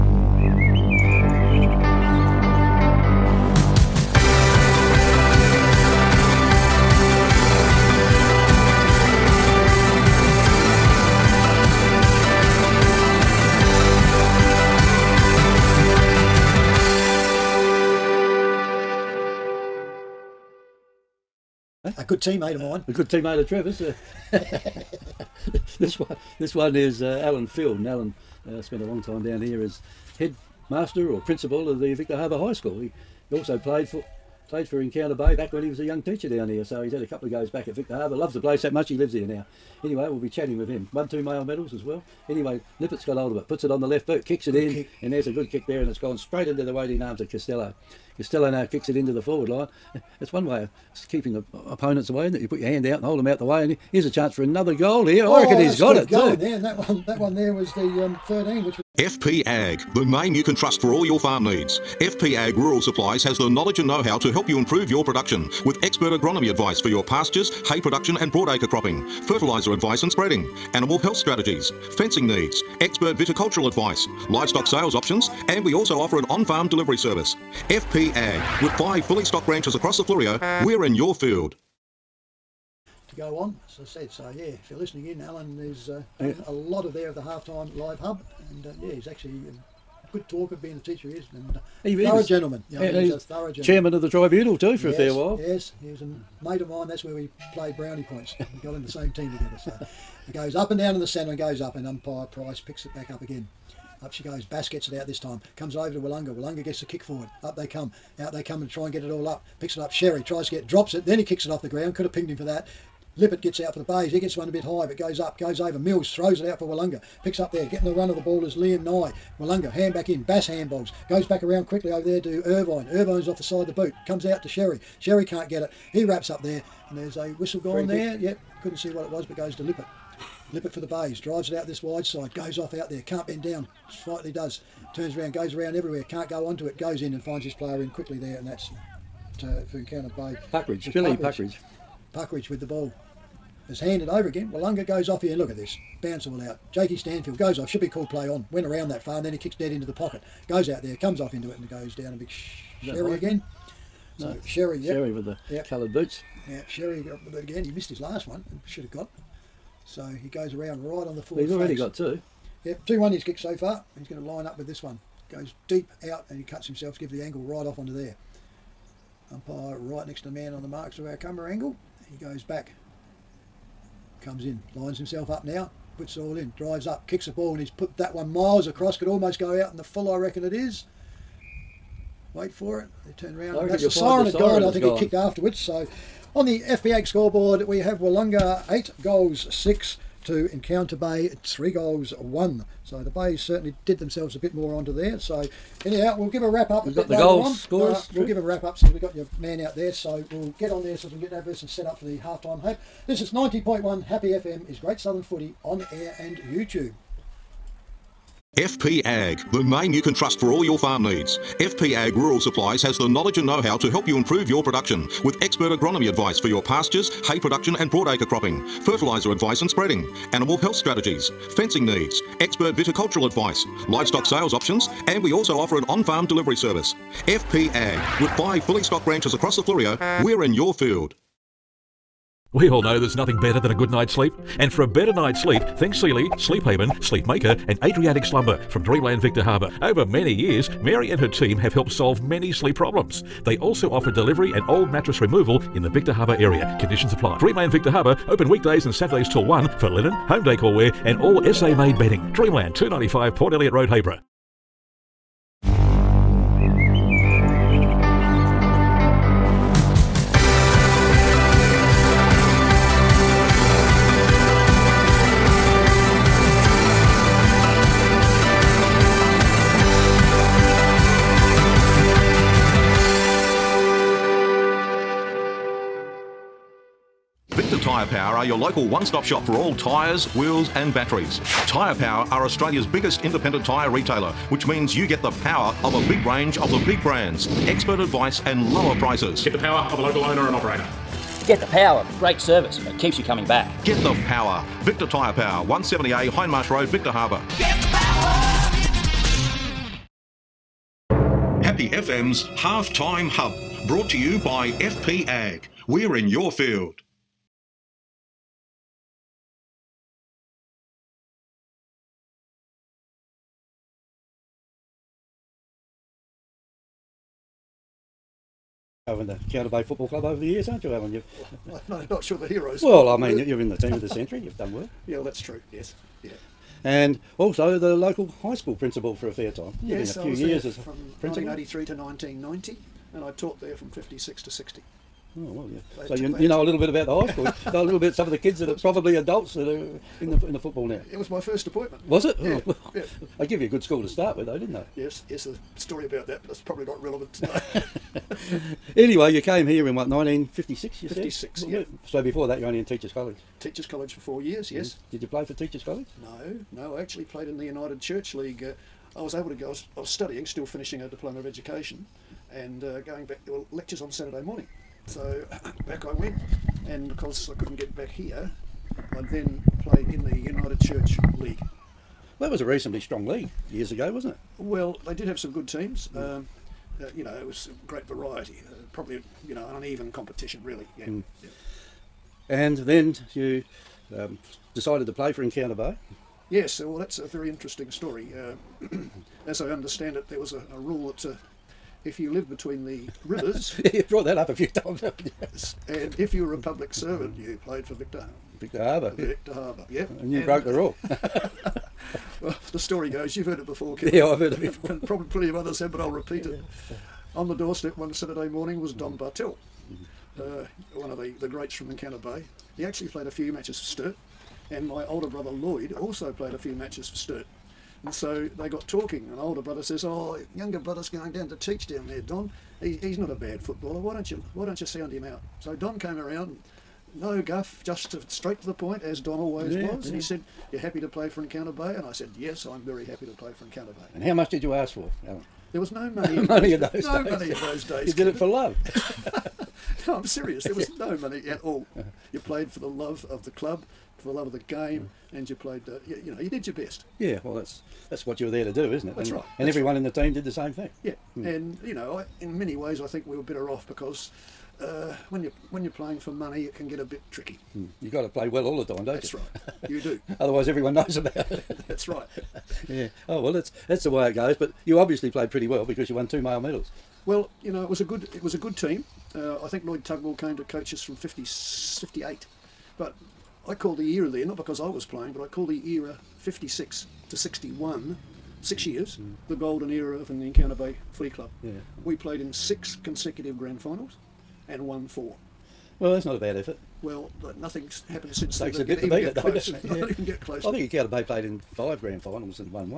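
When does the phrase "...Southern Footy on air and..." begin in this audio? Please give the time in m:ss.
3:24.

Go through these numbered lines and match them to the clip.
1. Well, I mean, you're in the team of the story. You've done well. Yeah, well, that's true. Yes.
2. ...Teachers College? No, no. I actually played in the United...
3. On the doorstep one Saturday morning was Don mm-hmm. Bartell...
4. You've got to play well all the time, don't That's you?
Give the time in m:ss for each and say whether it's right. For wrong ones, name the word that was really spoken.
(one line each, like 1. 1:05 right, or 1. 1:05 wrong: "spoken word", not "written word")
1. 5:22 wrong: "century", not "story"
2. 5:55 right
3. 6:47 right
4. 7:37 right.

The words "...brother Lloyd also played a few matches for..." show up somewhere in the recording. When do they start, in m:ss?
6:55.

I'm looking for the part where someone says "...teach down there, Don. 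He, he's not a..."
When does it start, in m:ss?
7:01.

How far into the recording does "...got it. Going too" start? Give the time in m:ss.
0:55.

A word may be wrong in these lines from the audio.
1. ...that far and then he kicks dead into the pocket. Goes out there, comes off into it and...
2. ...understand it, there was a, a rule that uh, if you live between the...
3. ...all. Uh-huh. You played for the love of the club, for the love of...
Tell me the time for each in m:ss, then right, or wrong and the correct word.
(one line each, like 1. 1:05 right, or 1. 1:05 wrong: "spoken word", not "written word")
1. 2:28 right
2. 6:29 right
3. 7:21 right.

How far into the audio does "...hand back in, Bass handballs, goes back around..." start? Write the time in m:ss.
1:59.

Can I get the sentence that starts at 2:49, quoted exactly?
Umpire right next to the man on the marks of our camera angle.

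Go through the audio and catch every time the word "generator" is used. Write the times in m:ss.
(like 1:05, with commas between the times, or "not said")
not said.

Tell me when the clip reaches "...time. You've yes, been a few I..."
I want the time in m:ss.
5:29.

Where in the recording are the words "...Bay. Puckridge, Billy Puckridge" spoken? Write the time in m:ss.
2:20.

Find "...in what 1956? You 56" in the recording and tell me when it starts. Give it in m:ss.
5:49.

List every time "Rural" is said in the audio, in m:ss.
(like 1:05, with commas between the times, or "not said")
1:02, 3:32.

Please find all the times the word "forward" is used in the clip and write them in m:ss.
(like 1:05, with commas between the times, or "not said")
0:49, 1:47.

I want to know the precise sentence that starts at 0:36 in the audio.
So he's had a couple of goes back at Victor Harbour.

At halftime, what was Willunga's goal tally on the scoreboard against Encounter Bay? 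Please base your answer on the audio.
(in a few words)
8 goals.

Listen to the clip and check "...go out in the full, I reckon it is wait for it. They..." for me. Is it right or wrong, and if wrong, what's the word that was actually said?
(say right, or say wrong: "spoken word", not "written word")
right.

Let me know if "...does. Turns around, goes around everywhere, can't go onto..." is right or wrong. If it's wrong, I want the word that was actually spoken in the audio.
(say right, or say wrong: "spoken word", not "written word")
right.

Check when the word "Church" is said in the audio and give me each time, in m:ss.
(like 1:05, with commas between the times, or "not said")
5:57, 6:10.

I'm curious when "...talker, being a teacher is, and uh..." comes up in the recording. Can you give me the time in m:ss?
1:30.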